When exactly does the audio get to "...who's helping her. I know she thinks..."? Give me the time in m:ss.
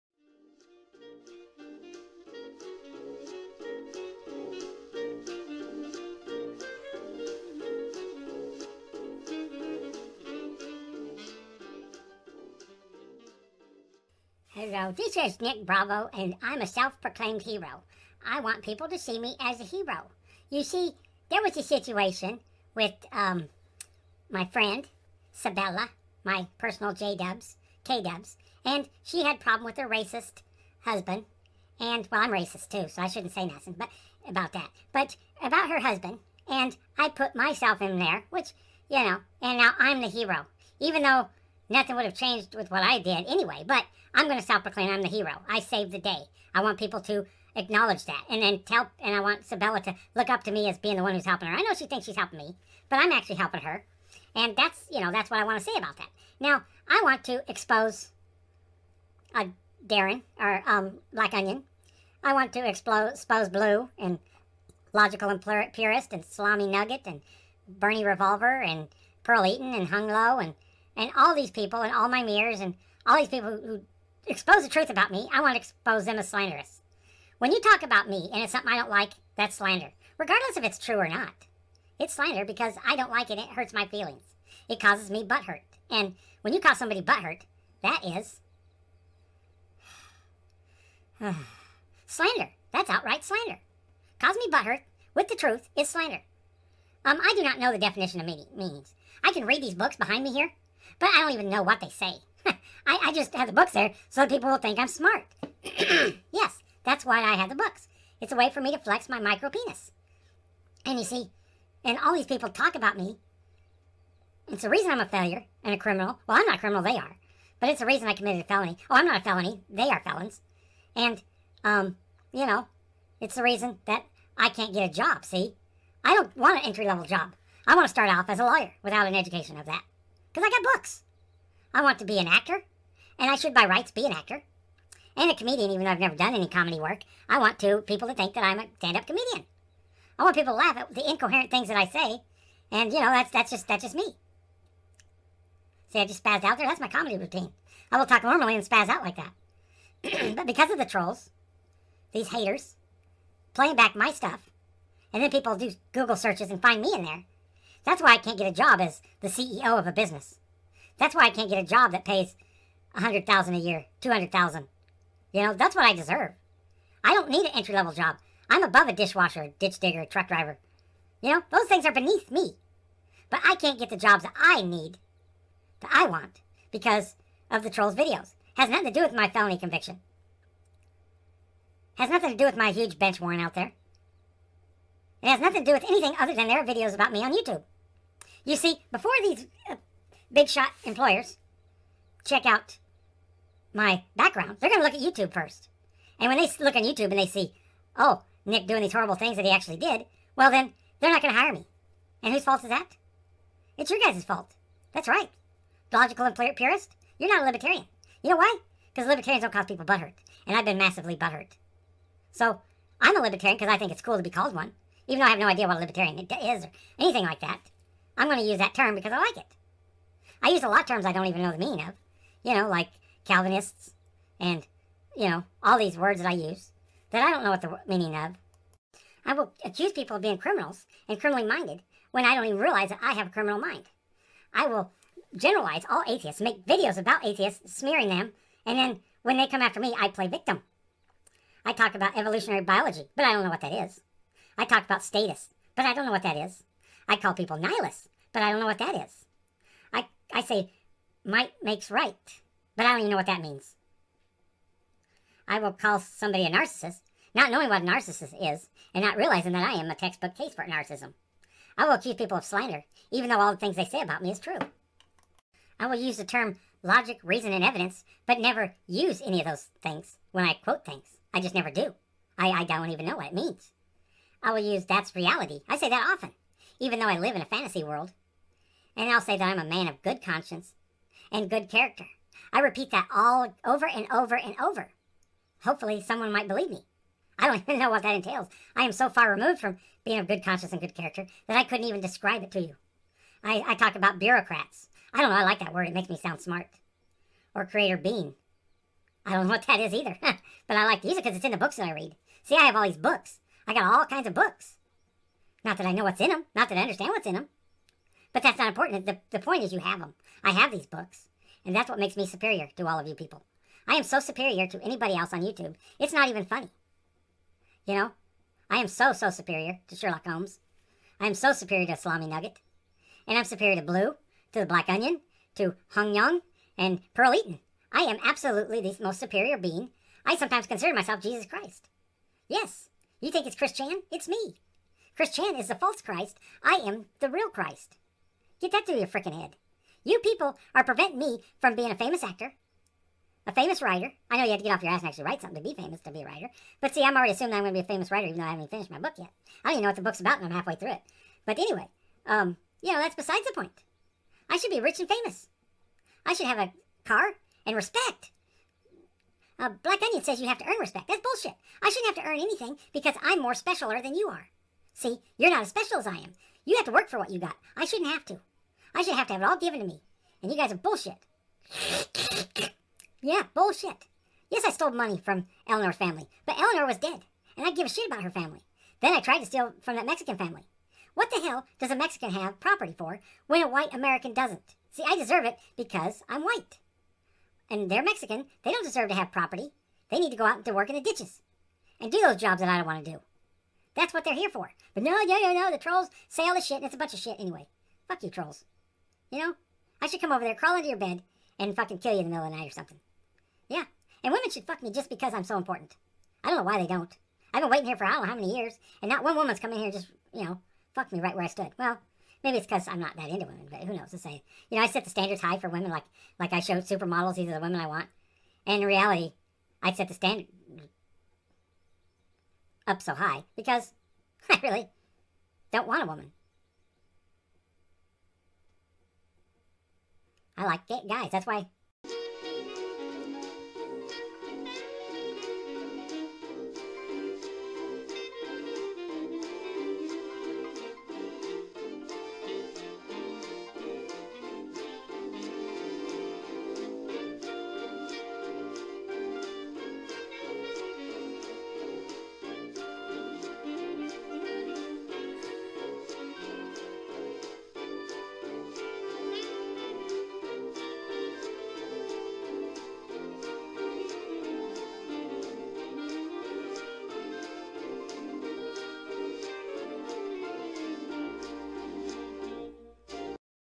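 0:51.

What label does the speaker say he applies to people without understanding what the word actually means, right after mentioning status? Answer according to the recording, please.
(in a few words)
Nihilists.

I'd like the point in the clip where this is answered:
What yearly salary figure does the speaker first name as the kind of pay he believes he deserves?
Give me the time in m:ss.
2:42.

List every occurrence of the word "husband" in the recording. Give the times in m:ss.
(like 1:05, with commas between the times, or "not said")
0:30, 0:35.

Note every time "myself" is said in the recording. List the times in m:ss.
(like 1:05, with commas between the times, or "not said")
0:37, 5:30.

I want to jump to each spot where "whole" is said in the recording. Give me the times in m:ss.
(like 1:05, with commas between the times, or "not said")
not said.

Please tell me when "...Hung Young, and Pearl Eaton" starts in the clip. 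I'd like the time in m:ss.
5:25.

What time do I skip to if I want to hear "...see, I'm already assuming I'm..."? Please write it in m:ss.
5:46.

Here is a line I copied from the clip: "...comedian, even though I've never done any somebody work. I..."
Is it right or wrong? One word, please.
wrong.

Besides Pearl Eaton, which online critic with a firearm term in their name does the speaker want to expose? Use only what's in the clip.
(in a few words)
Bernie Revolver.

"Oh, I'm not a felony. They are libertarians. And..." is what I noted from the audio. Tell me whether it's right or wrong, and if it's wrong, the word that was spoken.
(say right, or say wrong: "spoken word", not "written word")
wrong: "felons", not "libertarians".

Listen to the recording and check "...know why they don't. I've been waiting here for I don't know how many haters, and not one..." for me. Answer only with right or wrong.
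wrong.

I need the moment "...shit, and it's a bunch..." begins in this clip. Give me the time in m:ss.
6:36.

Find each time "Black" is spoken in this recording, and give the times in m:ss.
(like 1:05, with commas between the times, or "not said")
1:01, 5:24, 5:59.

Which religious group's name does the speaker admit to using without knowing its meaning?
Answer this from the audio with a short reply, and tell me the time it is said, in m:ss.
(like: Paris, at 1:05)
Calvinists, at 3:43.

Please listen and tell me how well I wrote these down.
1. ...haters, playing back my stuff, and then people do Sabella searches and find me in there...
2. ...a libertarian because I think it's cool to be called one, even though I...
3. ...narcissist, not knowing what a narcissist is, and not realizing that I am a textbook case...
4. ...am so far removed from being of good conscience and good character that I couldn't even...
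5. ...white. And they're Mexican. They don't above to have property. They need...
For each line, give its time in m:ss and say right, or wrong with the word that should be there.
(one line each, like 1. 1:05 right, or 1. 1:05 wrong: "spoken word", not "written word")
1. 2:32 wrong: "Google", not "Sabella"
2. 3:33 right
3. 4:16 right
4. 4:48 right
5. 6:26 wrong: "deserve", not "above".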